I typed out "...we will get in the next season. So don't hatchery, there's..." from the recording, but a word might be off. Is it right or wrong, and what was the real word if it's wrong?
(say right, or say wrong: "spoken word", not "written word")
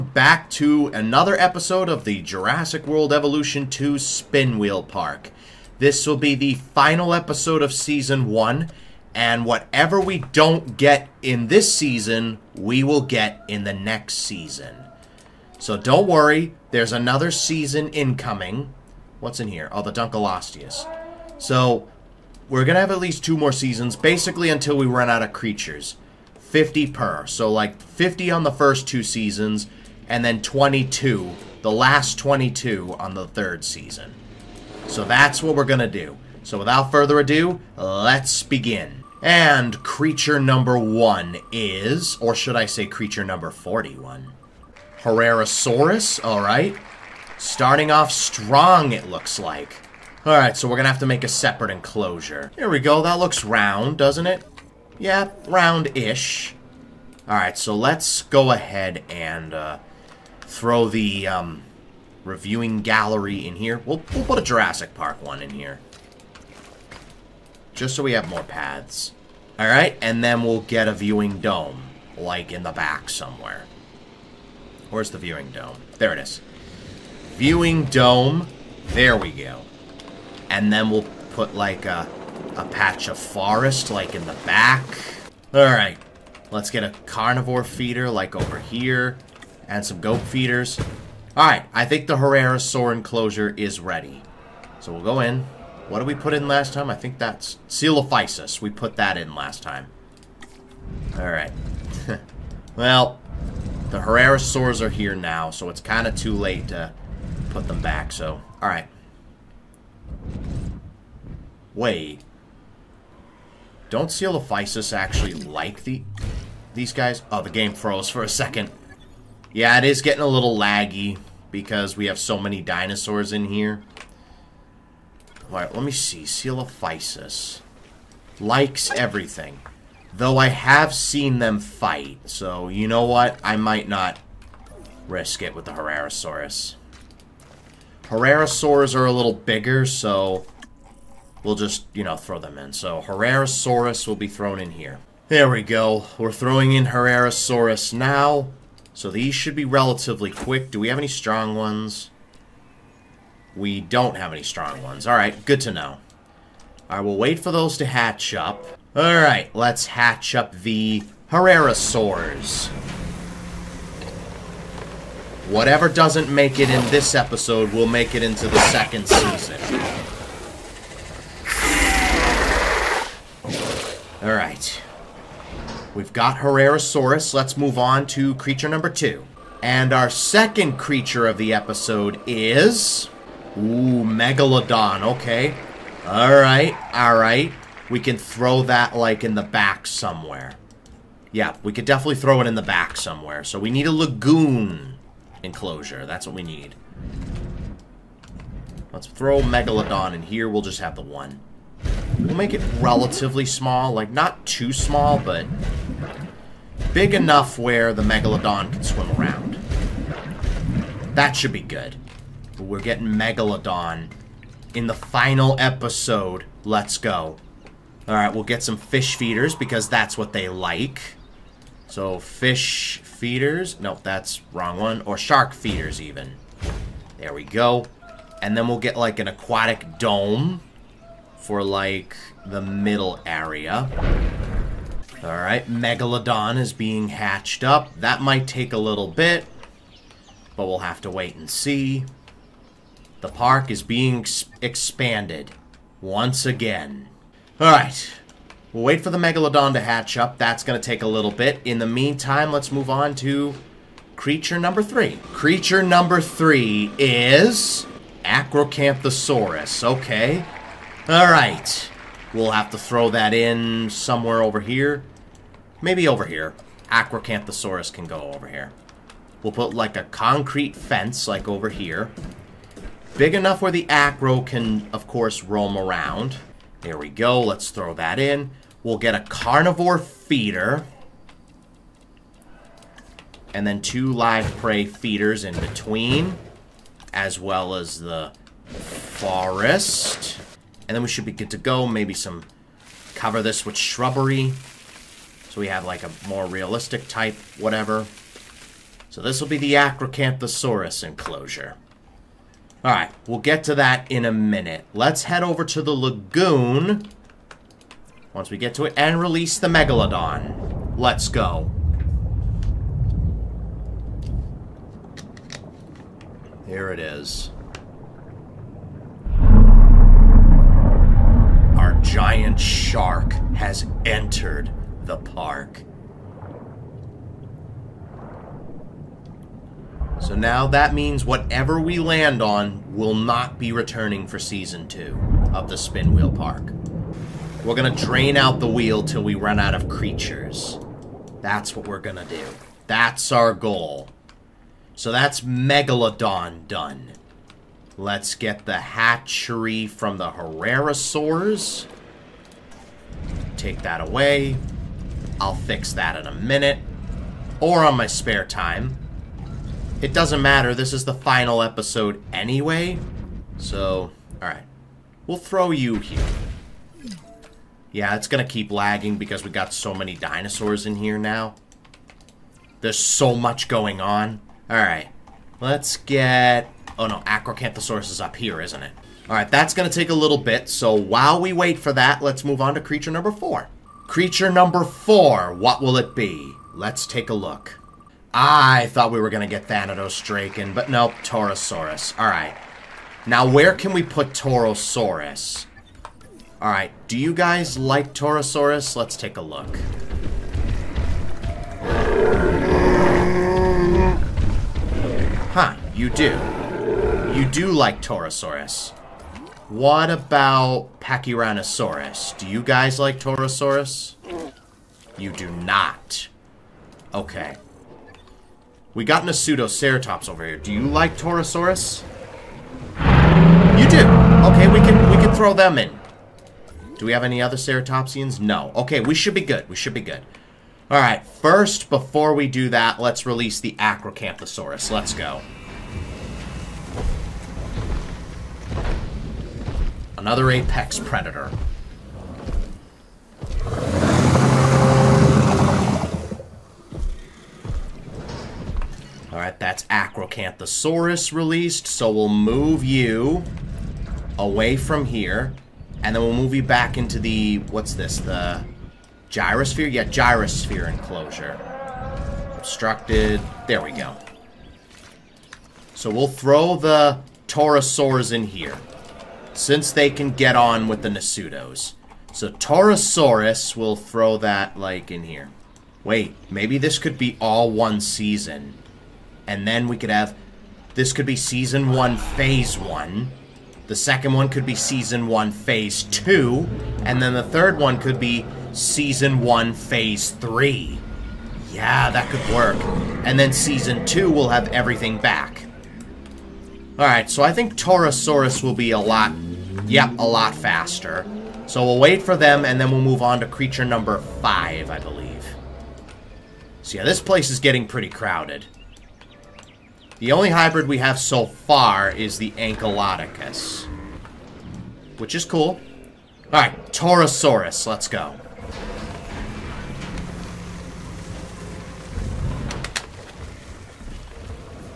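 wrong: "worry", not "hatchery".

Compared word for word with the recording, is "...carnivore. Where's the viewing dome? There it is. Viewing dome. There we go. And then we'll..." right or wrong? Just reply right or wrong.
wrong.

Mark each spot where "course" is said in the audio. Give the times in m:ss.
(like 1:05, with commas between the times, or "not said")
4:35.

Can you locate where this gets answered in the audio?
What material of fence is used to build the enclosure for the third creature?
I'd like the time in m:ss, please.
4:30.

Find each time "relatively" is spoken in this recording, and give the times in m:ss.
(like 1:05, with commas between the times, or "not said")
2:29, 3:22.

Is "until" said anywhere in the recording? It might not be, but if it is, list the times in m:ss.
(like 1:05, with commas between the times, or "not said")
0:24.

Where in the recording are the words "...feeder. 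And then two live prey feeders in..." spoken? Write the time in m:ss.
4:39.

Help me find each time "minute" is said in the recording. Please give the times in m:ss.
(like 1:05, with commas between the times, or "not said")
5:04, 5:56.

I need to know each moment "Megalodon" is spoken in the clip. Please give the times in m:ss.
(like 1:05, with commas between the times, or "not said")
3:04, 3:19, 3:28, 3:33, 3:55, 4:09, 5:09, 5:45.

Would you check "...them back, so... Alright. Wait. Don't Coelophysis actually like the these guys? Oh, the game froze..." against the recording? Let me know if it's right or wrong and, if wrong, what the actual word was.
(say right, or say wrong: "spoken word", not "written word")
right.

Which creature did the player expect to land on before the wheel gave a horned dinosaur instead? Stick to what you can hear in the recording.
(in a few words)
Thanatosdrakon.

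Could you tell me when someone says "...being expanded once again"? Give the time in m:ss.
4:03.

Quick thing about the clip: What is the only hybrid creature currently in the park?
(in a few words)
Ankylodocus.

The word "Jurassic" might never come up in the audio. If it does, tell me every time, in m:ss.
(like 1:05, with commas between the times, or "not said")
0:02, 1:04.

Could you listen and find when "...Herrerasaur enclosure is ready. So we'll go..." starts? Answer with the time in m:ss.
1:32.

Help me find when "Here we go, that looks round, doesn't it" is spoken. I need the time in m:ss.
0:52.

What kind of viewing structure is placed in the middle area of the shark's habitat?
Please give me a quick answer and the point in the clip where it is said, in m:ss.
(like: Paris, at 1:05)
Aquatic dome, at 3:49.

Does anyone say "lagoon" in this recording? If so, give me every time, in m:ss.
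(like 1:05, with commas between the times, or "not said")
3:13, 5:05.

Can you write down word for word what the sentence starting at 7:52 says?
So Torosaurus will throw that, like, in here.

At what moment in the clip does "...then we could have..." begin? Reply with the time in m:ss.
7:59.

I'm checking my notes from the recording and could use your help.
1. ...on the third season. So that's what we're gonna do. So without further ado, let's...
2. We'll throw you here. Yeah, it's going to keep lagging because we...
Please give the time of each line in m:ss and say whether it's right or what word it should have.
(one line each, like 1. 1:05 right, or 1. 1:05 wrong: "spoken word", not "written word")
1. 0:32 right
2. 6:05 right.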